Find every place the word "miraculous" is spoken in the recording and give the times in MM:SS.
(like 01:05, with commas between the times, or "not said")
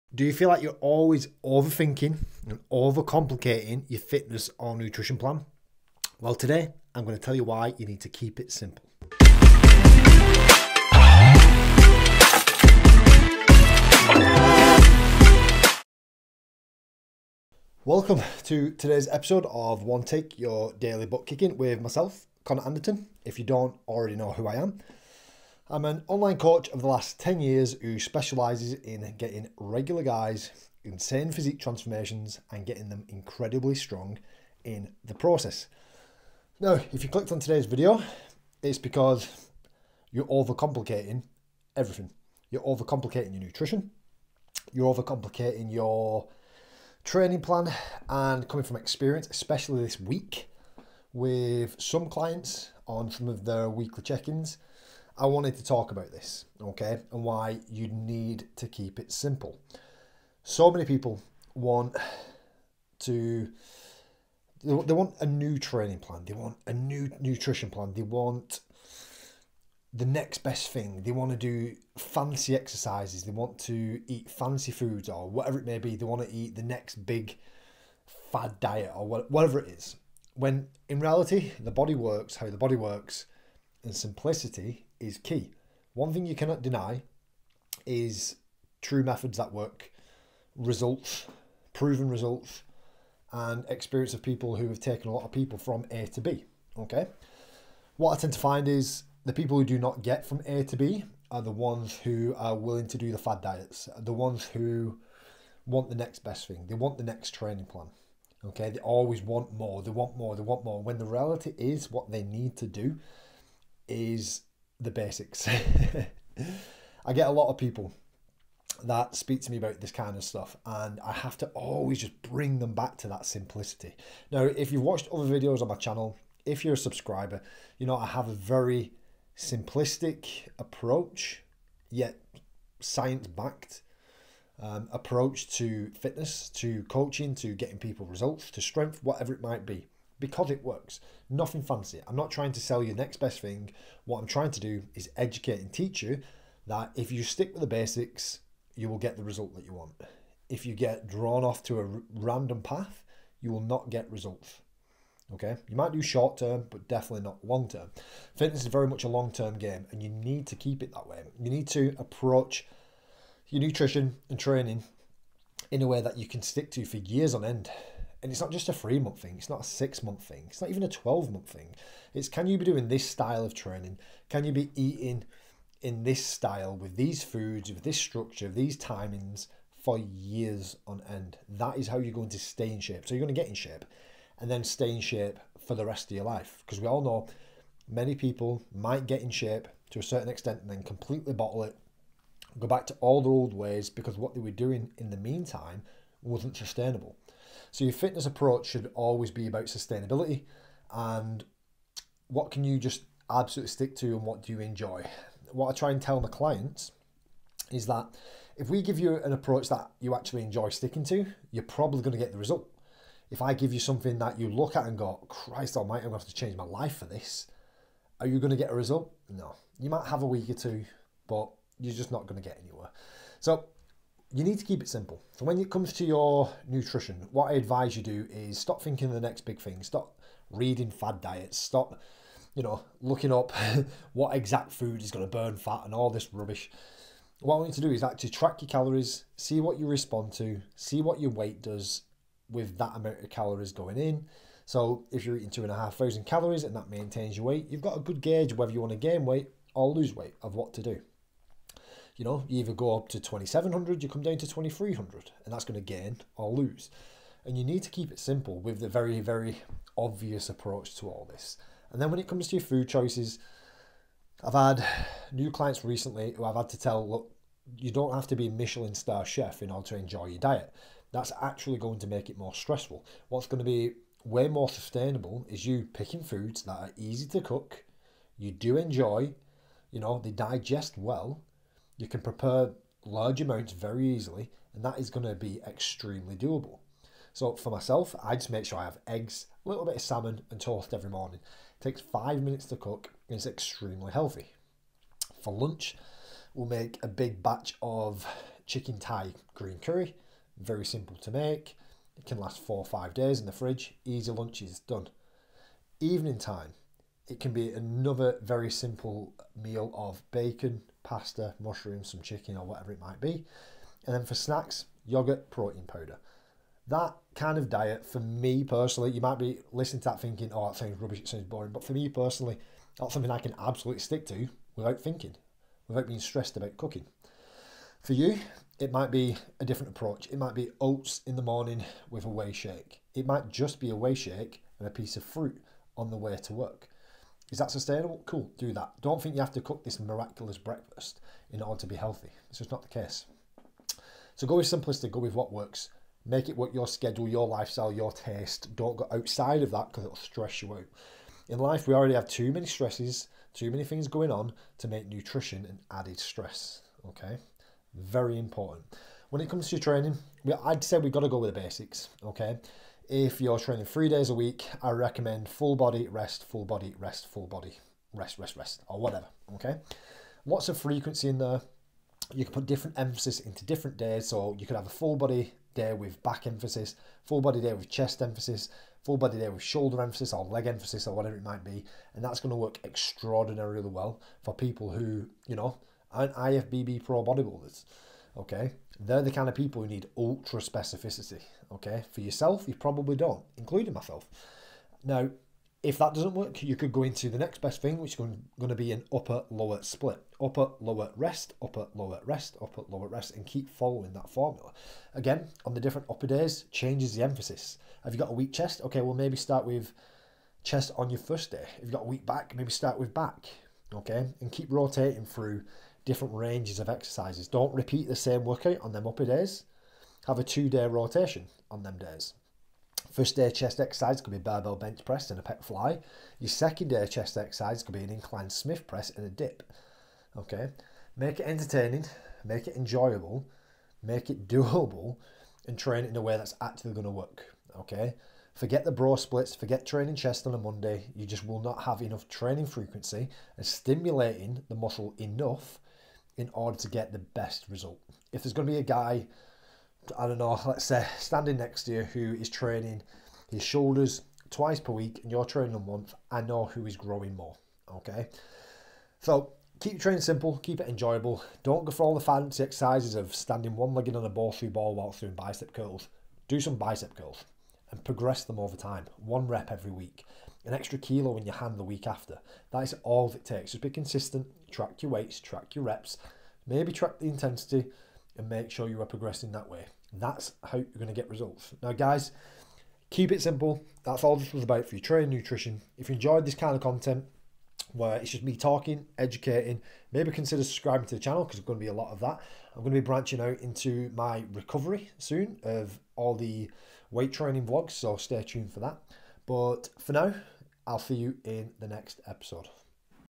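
05:39.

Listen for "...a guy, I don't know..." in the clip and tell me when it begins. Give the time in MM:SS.
07:28.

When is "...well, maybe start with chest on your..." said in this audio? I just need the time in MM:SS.
06:49.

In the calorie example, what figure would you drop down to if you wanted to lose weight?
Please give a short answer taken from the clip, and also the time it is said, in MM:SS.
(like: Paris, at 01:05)
2300, at 04:14.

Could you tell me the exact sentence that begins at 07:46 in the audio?
Do some bicep curls and progress them over time, one rep every week an extra kilo in your hand the week after.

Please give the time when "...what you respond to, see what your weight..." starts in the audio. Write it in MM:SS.
03:59.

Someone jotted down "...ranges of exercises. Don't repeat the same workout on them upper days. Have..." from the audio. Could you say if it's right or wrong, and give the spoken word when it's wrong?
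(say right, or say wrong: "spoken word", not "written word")
right.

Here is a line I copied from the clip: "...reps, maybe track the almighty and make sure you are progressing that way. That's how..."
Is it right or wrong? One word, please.
wrong.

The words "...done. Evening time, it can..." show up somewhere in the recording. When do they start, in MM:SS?
05:04.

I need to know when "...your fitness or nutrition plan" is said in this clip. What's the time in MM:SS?
00:03.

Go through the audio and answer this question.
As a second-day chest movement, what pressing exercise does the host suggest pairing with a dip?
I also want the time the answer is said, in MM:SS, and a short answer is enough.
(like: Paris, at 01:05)
inclined Smith press, at 07:08.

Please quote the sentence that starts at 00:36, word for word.
Now, if you clicked on today's video, it's because you're overcomplicating everything.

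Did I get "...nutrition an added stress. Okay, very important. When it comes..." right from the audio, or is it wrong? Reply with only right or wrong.
right.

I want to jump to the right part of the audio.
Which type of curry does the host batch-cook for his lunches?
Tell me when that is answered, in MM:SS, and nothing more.
04:58.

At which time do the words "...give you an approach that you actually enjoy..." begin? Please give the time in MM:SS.
03:28.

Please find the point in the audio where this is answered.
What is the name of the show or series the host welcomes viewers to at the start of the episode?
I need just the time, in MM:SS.
00:19.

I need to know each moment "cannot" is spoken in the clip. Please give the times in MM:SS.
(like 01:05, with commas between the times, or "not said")
01:26.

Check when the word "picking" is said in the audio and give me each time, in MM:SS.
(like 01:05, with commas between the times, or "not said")
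04:35.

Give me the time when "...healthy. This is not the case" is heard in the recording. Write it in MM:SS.
05:41.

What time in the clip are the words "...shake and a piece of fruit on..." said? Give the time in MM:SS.
05:34.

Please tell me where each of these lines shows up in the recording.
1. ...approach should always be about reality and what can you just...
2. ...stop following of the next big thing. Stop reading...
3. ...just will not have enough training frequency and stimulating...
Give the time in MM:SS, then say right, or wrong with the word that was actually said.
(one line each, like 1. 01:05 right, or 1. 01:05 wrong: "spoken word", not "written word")
1. 03:18 wrong: "sustainability", not "reality"
2. 03:48 wrong: "thinking", not "following"
3. 07:21 right.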